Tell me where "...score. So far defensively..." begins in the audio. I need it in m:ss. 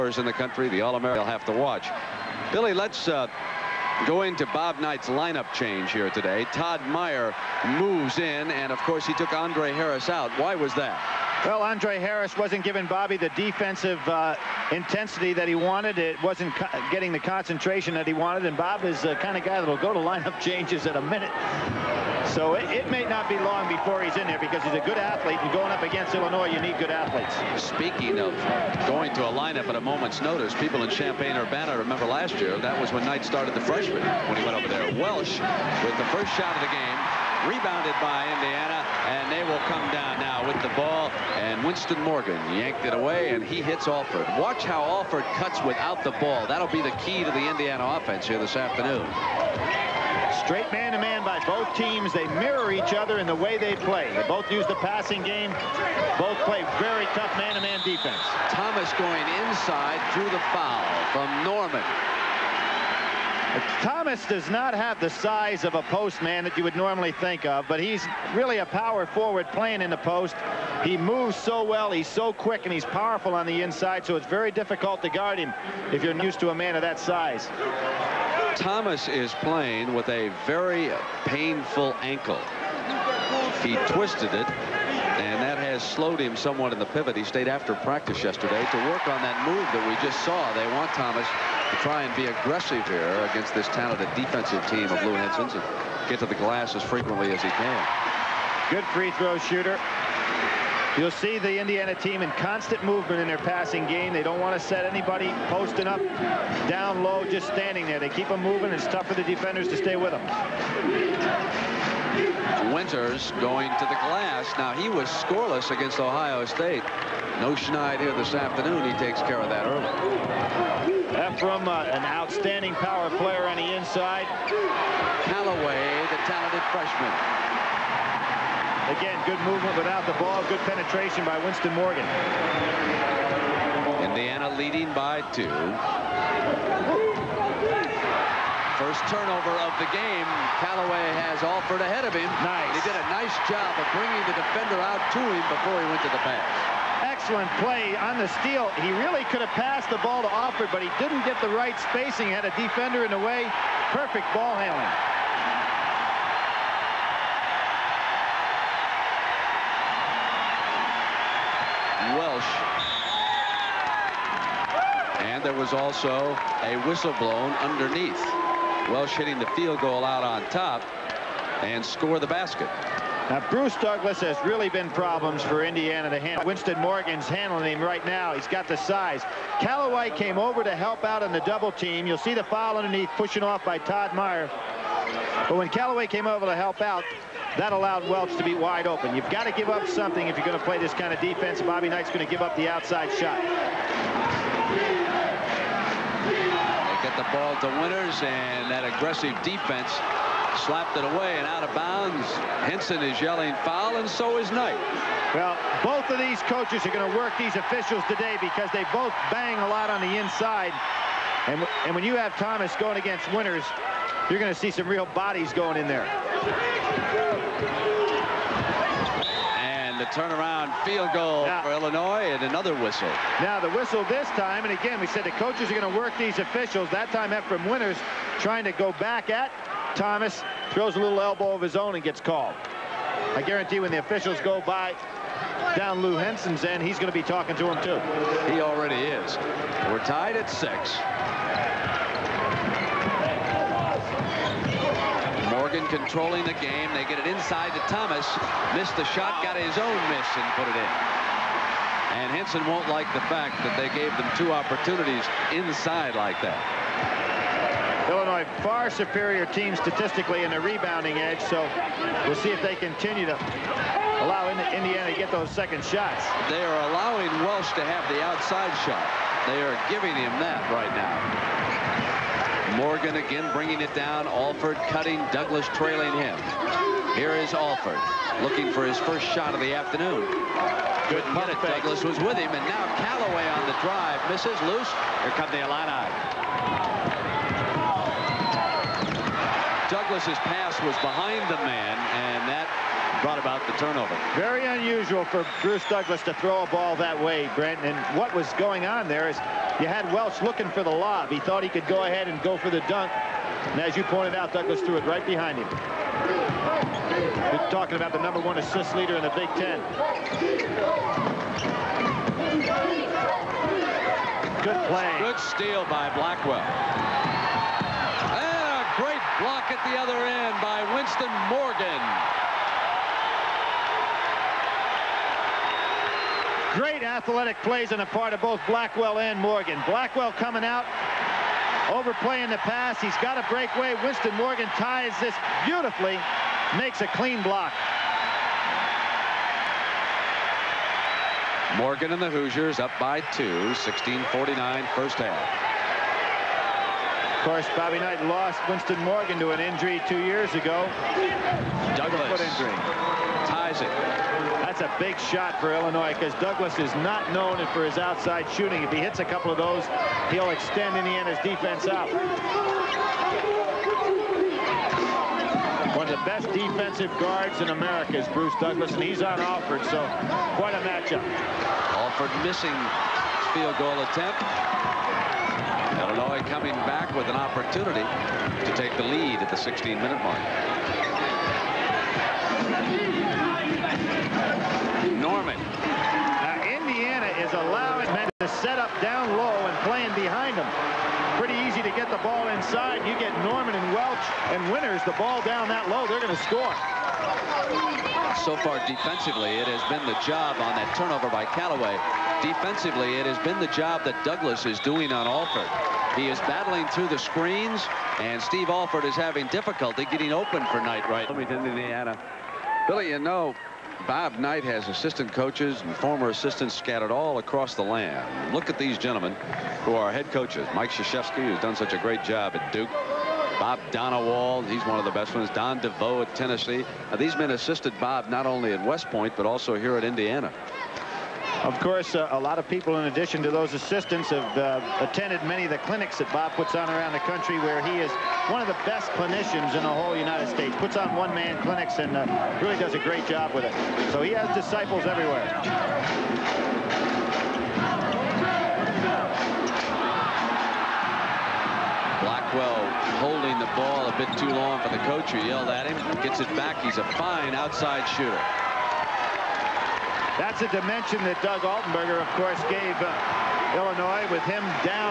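6:36.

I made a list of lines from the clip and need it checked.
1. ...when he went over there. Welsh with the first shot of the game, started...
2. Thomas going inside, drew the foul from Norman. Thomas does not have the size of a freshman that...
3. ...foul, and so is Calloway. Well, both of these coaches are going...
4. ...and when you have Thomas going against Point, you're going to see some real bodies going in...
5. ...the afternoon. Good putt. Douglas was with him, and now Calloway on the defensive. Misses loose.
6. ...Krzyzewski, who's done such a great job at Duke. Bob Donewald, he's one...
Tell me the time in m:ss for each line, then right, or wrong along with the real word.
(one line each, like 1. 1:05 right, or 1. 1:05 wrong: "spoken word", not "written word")
1. 0:34 wrong: "rebounded", not "started"
2. 0:58 wrong: "postman", not "freshman"
3. 3:23 wrong: "Knight", not "Calloway"
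4. 3:31 wrong: "Winters", not "Point"
5. 4:39 wrong: "drive", not "defensive"
6. 7:00 right.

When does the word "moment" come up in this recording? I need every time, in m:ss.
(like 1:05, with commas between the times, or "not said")
0:29.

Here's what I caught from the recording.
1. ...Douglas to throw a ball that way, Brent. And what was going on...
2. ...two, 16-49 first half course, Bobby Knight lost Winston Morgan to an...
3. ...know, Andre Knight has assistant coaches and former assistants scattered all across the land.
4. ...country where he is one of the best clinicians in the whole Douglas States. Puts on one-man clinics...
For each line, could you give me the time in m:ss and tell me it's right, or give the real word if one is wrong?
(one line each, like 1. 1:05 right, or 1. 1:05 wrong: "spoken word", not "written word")
1. 4:55 right
2. 5:43 right
3. 6:53 wrong: "Bob", not "Andre"
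4. 7:17 wrong: "United", not "Douglas".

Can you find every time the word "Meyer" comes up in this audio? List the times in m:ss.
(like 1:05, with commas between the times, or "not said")
0:06, 3:04.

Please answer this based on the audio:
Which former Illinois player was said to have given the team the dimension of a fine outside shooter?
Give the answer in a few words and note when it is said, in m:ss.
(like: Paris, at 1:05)
Doug Altenberger, at 7:41.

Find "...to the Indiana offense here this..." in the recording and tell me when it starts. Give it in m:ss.
0:47.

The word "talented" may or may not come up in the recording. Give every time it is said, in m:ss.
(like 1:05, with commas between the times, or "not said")
1:33, 2:06.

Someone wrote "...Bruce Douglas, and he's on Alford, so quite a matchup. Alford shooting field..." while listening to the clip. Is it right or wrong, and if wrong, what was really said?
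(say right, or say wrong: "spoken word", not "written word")
wrong: "missing", not "shooting".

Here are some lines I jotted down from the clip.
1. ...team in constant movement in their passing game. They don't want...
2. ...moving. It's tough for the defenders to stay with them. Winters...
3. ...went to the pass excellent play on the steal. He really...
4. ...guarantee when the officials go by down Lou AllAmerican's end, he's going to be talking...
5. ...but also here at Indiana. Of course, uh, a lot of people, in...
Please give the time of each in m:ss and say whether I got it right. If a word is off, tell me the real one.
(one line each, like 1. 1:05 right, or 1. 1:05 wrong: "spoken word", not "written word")
1. 1:41 right
2. 1:48 right
3. 2:25 right
4. 3:53 wrong: "Henson", not "AllAmerican"
5. 7:09 right.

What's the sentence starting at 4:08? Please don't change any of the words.
Missed the shot, got his own miss and put it in.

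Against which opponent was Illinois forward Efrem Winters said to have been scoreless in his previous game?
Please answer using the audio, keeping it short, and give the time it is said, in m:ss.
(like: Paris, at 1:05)
Ohio State, at 1:55.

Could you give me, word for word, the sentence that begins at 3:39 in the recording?
And the turnaround field goal now, for Illinois and another whistle.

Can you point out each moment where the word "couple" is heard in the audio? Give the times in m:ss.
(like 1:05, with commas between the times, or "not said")
5:59.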